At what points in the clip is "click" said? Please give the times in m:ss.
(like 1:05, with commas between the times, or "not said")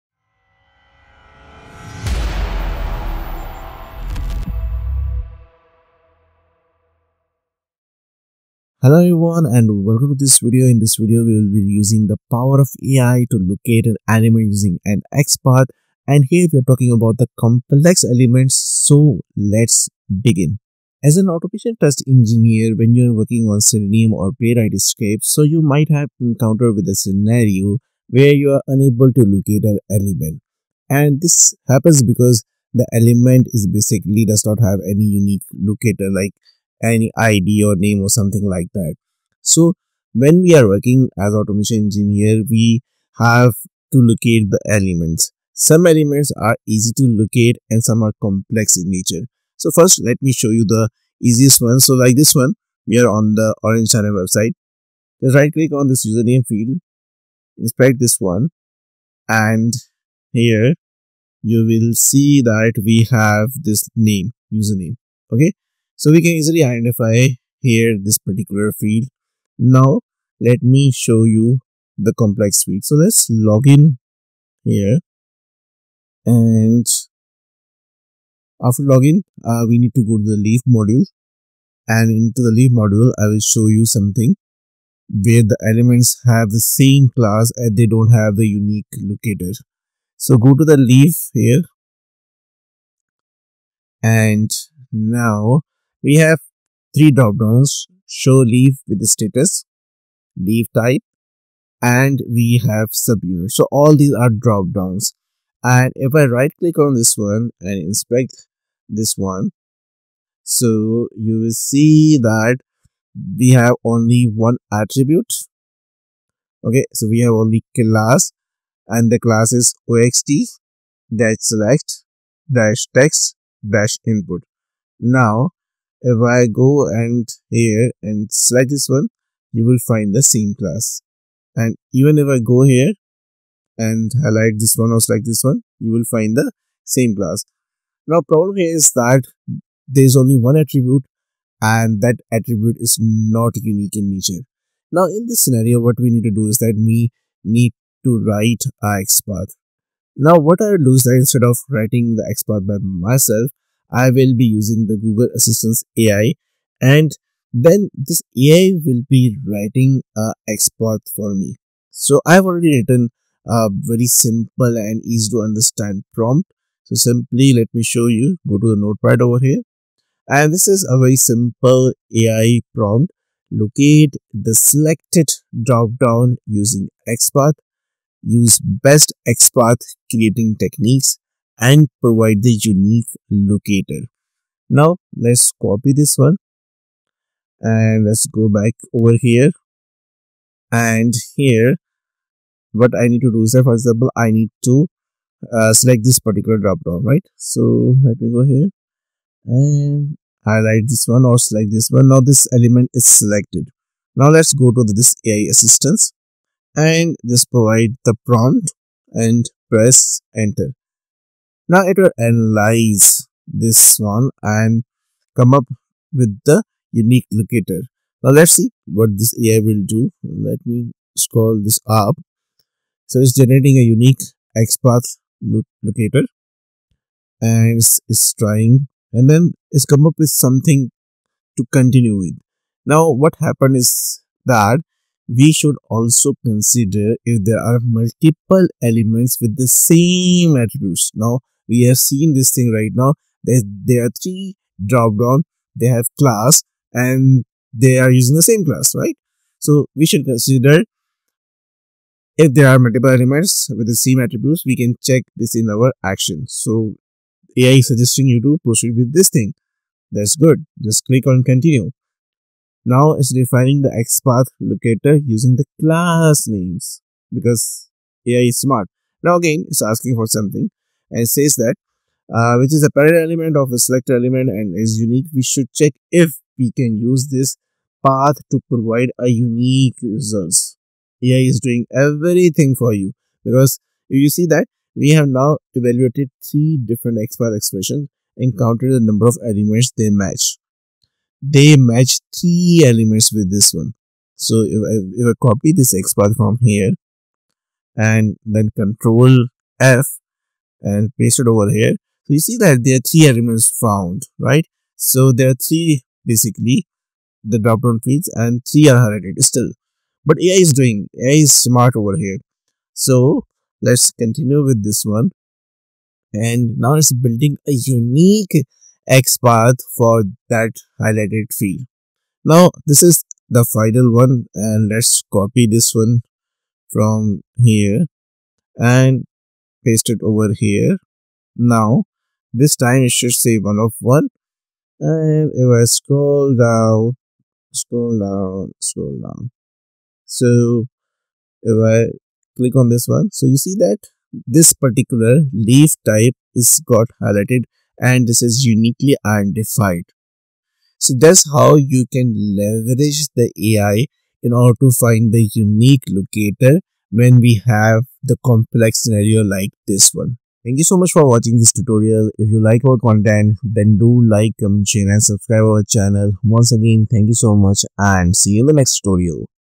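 0:55, 1:46, 4:21, 5:42.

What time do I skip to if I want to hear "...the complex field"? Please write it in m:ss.
1:11.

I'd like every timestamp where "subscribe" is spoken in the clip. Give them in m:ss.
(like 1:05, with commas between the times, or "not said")
6:05.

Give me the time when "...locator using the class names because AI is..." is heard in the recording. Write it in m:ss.
4:24.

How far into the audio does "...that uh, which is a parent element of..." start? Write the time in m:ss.
4:31.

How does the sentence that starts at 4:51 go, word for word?
They match three elements with this one.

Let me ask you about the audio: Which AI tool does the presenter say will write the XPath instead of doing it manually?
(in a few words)
Google Assistance AI.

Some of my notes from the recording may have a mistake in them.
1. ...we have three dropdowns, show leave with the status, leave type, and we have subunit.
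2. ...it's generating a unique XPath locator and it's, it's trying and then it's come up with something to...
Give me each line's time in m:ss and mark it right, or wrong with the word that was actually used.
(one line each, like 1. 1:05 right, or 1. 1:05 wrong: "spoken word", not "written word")
1. 1:36 right
2. 3:43 right.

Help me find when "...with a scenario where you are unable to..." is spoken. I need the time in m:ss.
0:26.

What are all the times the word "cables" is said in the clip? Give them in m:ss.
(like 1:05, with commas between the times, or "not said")
not said.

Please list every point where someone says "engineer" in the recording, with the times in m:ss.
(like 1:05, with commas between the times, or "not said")
0:22, 0:41.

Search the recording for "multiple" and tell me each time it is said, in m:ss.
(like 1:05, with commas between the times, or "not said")
3:57, 4:12.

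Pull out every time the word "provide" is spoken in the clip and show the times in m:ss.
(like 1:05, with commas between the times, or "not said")
3:02, 3:27, 4:38.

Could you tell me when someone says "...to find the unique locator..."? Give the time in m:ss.
5:54.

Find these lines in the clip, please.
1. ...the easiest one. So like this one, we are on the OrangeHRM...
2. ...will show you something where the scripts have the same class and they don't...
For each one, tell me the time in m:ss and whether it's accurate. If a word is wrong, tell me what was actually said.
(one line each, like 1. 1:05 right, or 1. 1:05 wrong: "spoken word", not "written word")
1. 0:50 right
2. 1:23 wrong: "elements", not "scripts".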